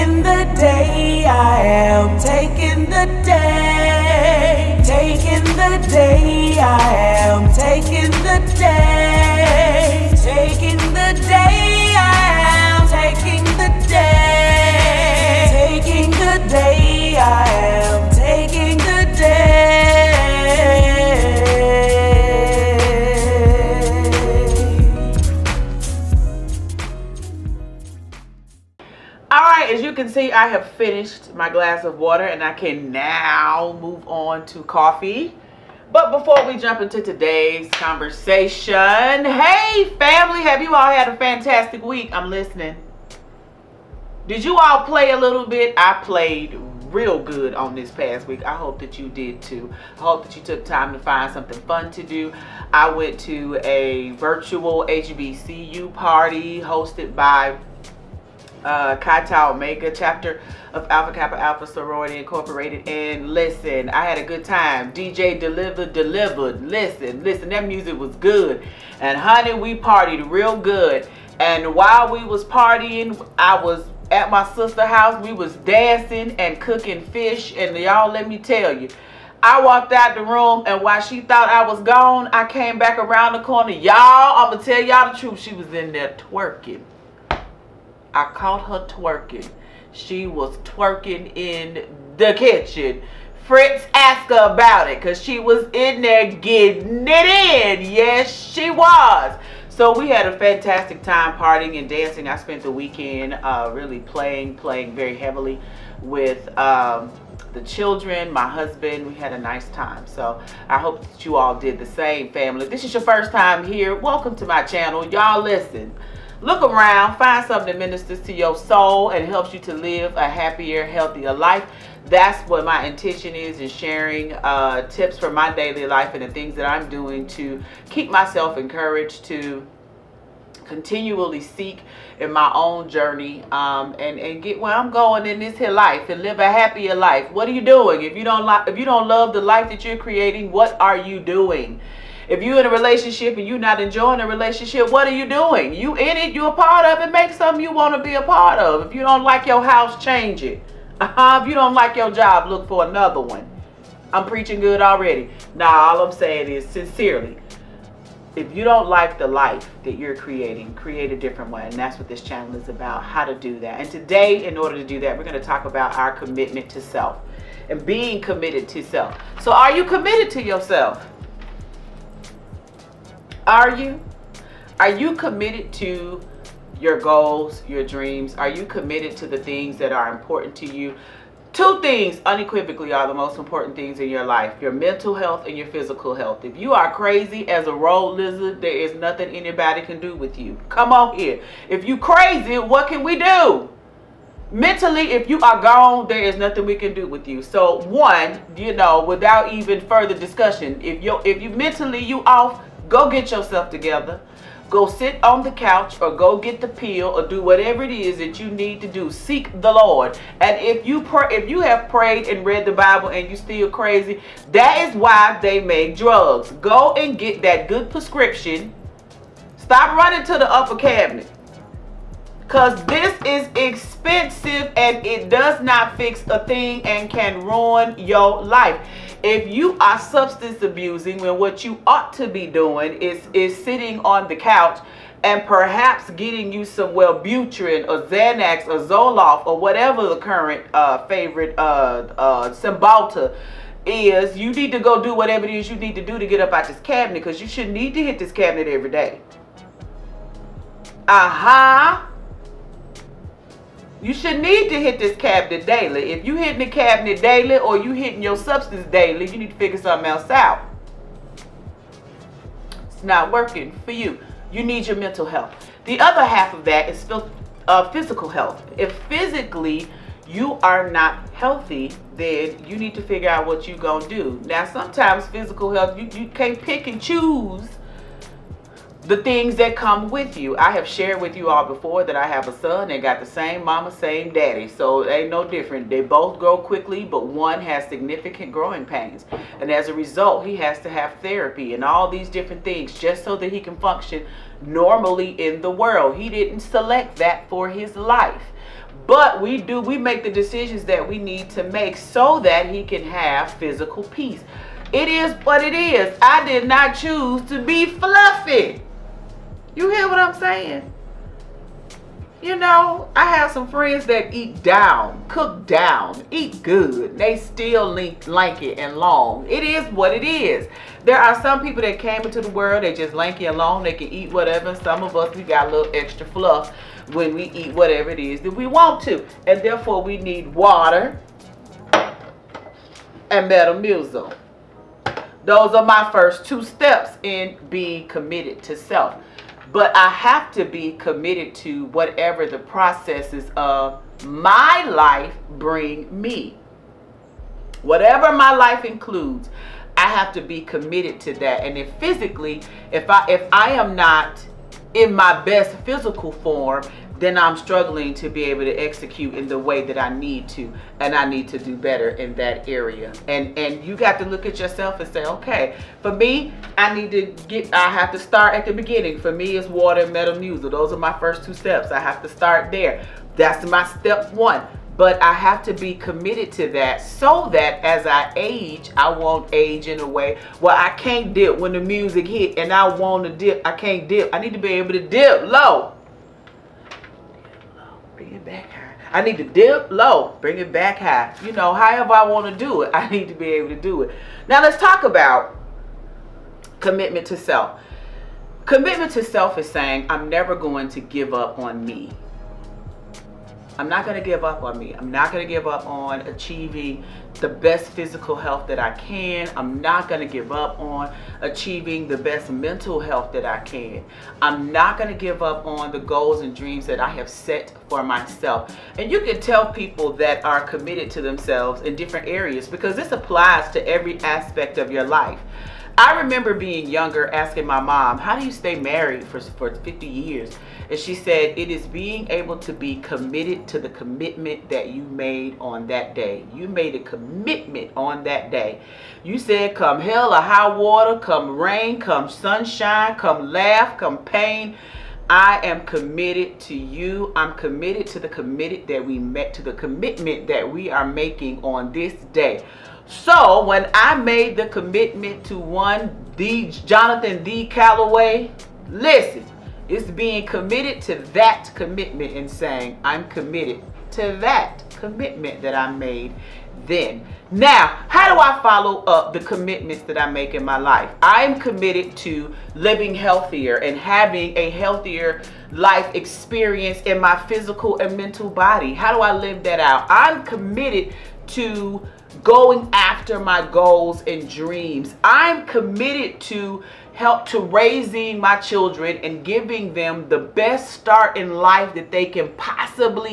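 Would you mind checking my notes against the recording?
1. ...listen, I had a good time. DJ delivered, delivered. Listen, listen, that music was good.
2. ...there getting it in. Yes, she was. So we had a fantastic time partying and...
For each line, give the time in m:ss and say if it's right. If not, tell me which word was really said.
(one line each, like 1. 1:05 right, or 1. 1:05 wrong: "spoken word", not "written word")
1. 1:03 right
2. 1:36 right.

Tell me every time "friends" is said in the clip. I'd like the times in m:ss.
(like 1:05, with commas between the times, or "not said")
5:13.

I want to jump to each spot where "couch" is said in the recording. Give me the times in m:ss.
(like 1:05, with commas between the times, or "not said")
3:25, 3:54.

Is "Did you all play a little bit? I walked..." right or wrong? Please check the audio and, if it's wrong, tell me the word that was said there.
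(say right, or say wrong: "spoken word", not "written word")
wrong: "played", not "walked".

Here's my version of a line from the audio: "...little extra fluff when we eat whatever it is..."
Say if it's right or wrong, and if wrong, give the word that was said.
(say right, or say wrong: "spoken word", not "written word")
right.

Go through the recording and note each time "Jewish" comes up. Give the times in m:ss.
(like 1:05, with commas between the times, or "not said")
not said.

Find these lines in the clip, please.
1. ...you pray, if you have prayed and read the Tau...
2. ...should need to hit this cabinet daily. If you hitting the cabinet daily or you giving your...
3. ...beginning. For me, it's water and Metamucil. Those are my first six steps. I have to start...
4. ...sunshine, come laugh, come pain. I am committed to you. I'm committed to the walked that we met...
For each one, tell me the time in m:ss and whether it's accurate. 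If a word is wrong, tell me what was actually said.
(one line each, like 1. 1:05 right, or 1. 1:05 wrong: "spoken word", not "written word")
1. 3:30 wrong: "Bible", not "Tau"
2. 4:14 wrong: "hitting", not "giving"
3. 6:08 wrong: "two", not "six"
4. 7:22 wrong: "committed", not "walked".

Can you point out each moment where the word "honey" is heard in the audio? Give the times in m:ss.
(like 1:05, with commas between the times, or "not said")
1:09.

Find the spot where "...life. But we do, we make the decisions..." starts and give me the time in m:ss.
4:57.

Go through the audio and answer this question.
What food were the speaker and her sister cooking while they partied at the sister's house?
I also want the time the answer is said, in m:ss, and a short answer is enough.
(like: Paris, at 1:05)
Fish, at 1:17.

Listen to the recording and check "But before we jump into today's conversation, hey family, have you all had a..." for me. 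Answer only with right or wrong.
right.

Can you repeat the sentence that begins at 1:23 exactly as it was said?
Y'all, I'm going to tell y'all the truth.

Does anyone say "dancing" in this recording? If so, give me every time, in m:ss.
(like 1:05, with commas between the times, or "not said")
1:15, 1:41.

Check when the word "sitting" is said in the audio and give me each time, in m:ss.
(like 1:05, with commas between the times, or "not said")
3:53.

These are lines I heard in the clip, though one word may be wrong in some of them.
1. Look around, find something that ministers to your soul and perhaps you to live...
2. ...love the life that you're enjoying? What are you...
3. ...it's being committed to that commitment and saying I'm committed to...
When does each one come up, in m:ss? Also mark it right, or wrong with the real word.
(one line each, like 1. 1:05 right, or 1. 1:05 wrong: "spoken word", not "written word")
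1. 1:56 wrong: "helps", not "perhaps"
2. 2:19 wrong: "creating", not "enjoying"
3. 7:39 right.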